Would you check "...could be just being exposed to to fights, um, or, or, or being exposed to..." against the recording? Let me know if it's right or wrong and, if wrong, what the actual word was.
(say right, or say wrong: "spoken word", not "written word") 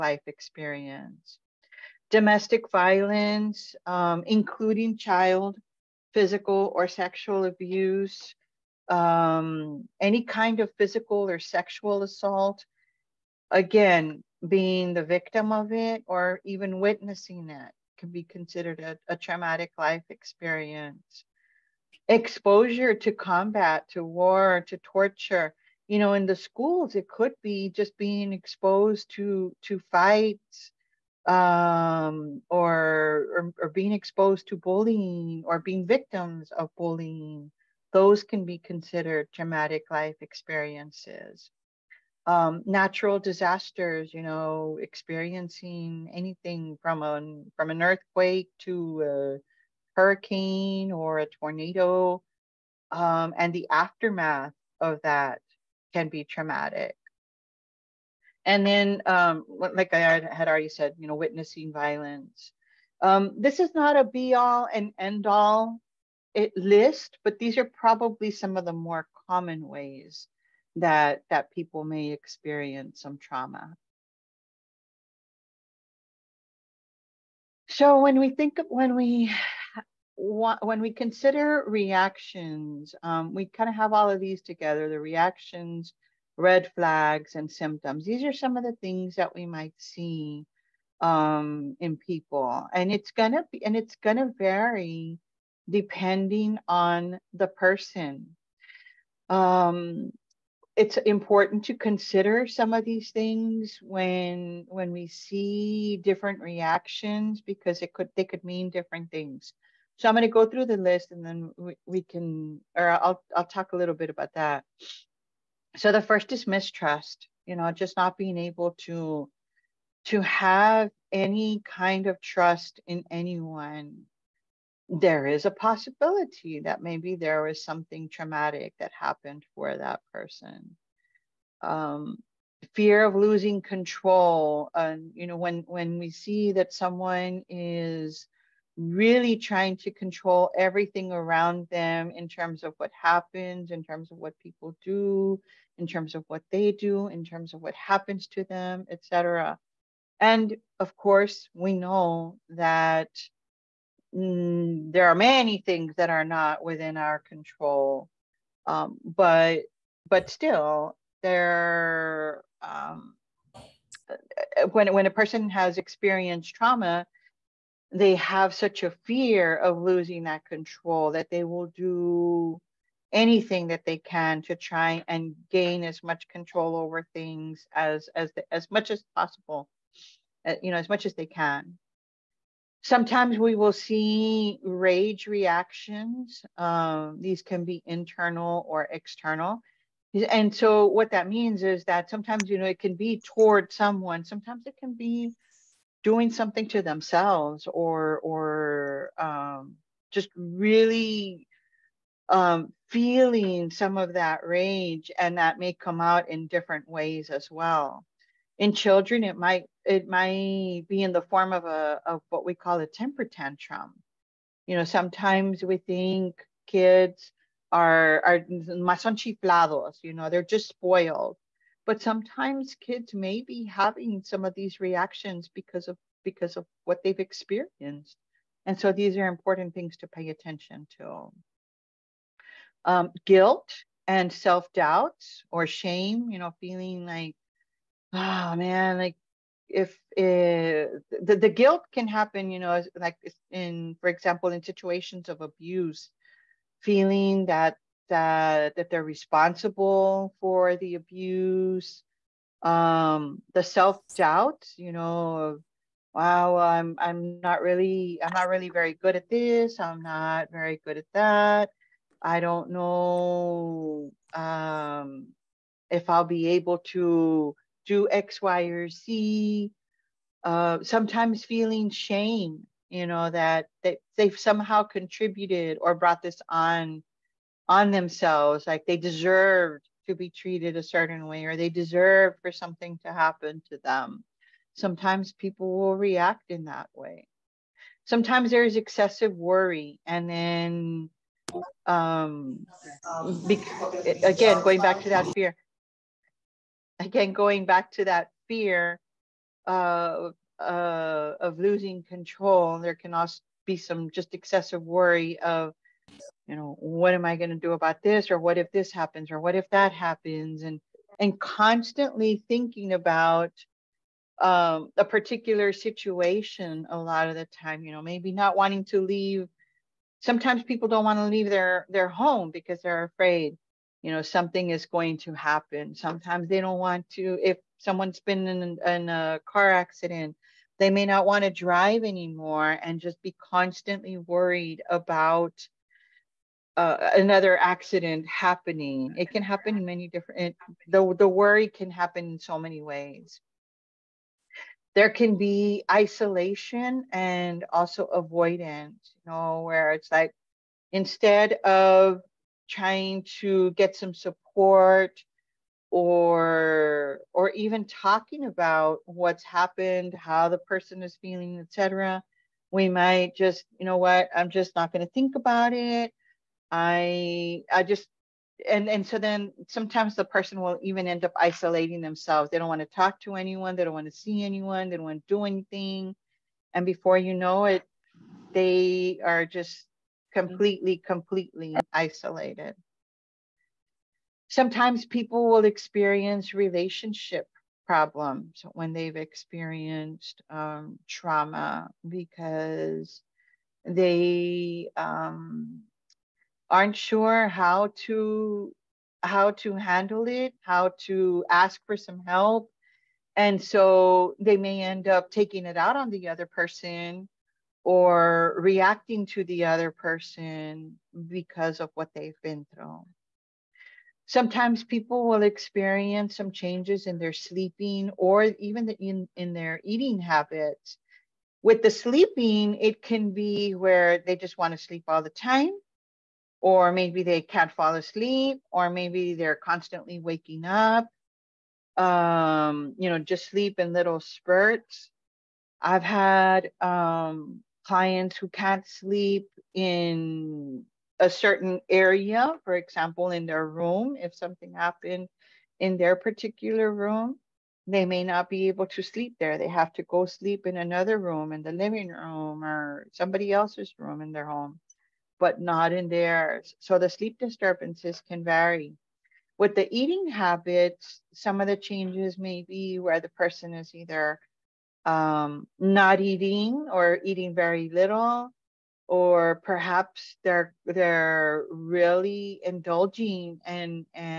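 right.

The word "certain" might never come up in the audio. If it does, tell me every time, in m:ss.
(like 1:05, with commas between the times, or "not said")
4:40, 7:21.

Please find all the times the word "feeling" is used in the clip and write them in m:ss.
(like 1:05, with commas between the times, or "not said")
3:22, 3:56, 4:06, 4:31, 6:01.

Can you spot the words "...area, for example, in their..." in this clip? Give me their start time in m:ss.
7:21.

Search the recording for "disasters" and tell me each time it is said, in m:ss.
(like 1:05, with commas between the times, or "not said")
0:43.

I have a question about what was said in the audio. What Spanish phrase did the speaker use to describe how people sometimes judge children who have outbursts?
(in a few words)
más chiflados.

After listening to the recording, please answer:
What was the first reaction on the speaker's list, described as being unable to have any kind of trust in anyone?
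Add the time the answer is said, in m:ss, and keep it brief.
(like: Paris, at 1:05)
mistrust, at 1:56.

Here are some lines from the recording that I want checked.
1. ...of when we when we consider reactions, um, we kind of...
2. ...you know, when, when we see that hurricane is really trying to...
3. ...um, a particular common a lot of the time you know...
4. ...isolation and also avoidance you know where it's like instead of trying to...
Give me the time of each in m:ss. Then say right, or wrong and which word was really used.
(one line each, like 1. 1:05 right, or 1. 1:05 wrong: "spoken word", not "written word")
1. 1:18 right
2. 2:15 wrong: "someone", not "hurricane"
3. 5:14 wrong: "situation", not "common"
4. 5:45 right.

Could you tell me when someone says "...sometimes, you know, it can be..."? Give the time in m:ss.
3:12.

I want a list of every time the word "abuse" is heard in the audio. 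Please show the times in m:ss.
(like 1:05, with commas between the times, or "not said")
0:07, 4:05, 4:10.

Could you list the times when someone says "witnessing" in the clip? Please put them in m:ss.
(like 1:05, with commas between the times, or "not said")
0:16, 1:01.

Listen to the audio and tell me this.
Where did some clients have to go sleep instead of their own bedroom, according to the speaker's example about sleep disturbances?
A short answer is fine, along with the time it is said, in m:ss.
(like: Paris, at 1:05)
the living room, at 7:31.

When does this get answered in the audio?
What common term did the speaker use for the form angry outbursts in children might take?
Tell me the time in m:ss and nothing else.
3:32.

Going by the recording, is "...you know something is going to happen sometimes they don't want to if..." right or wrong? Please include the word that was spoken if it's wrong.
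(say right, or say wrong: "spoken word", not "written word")
right.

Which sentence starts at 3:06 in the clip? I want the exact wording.
Um, these can be internal or external.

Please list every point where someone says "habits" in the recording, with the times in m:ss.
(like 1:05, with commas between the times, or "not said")
7:00, 7:40.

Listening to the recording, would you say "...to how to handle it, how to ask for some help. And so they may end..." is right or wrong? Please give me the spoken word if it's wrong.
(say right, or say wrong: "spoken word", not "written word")
right.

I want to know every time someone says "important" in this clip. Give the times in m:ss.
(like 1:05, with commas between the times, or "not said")
1:40, 3:49.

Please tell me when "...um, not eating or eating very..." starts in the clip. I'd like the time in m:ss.
7:45.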